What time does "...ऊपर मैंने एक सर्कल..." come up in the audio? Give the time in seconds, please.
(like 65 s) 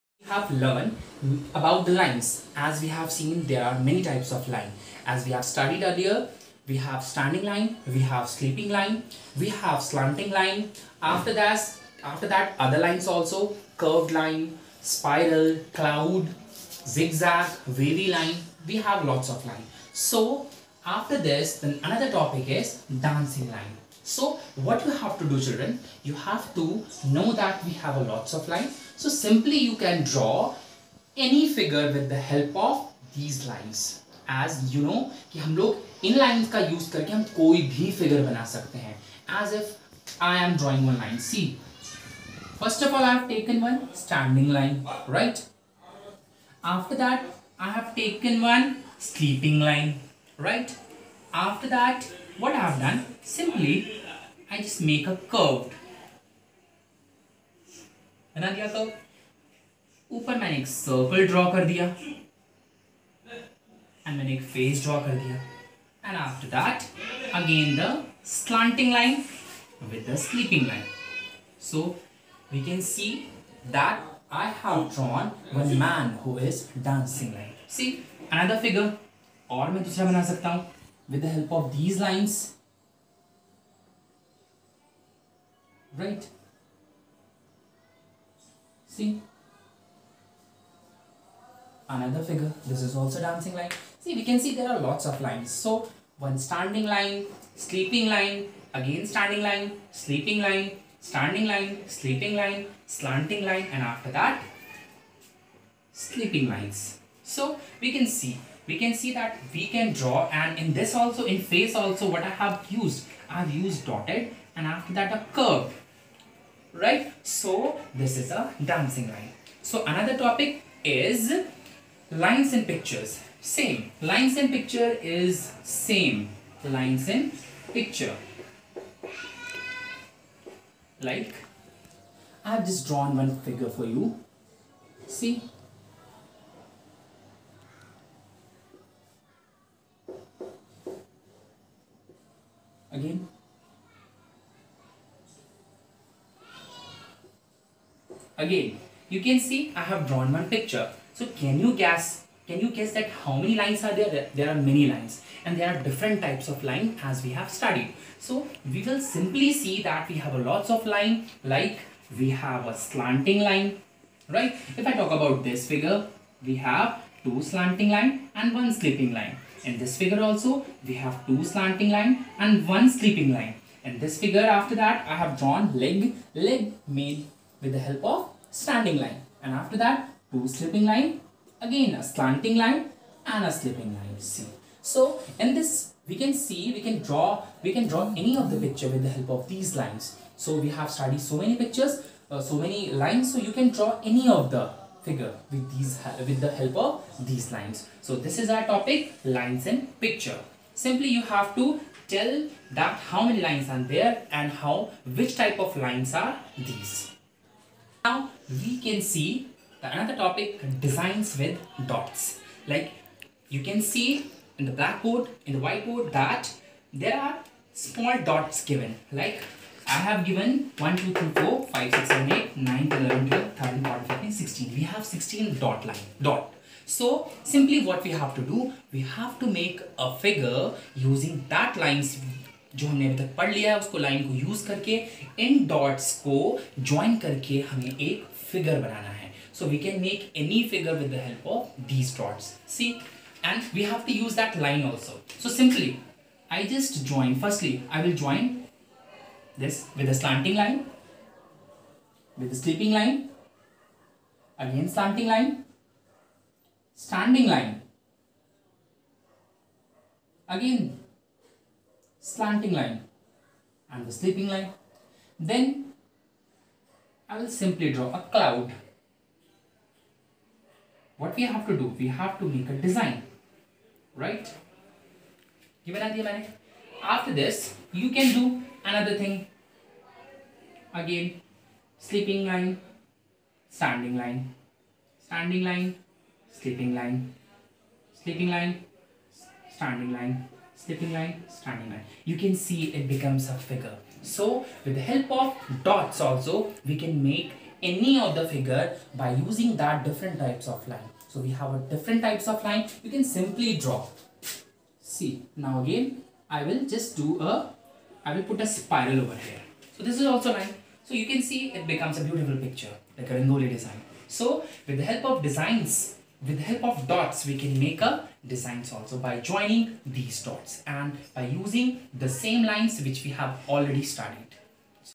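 60 s.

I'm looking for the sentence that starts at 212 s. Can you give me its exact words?
Like you can see in the blackboard, in the whiteboard that there are small dots given.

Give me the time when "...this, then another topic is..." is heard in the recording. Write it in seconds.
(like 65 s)
21 s.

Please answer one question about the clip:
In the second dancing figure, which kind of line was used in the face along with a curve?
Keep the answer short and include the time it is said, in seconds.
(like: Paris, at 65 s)
dotted, at 113 s.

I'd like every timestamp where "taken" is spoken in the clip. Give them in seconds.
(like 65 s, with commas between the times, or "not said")
43 s, 47 s.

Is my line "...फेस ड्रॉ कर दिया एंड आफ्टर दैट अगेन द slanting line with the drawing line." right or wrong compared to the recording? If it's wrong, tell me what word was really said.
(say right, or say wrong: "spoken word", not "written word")
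wrong: "sleeping", not "drawing".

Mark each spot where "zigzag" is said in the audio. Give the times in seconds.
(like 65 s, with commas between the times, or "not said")
16 s.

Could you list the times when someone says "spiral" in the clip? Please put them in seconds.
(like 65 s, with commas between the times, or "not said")
14 s, 308 s.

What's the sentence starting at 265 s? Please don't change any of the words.
Then I will simply draw a cloud.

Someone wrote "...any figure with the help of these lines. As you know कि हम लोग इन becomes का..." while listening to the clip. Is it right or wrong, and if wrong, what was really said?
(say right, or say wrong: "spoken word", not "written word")
wrong: "lines", not "becomes".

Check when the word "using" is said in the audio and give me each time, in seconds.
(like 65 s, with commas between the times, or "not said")
230 s, 299 s, 321 s.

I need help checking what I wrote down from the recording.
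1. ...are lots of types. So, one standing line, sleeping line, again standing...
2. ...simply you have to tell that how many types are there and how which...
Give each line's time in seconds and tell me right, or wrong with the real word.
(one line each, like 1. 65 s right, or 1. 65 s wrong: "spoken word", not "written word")
1. 94 s wrong: "lines", not "types"
2. 200 s wrong: "lines", not "types".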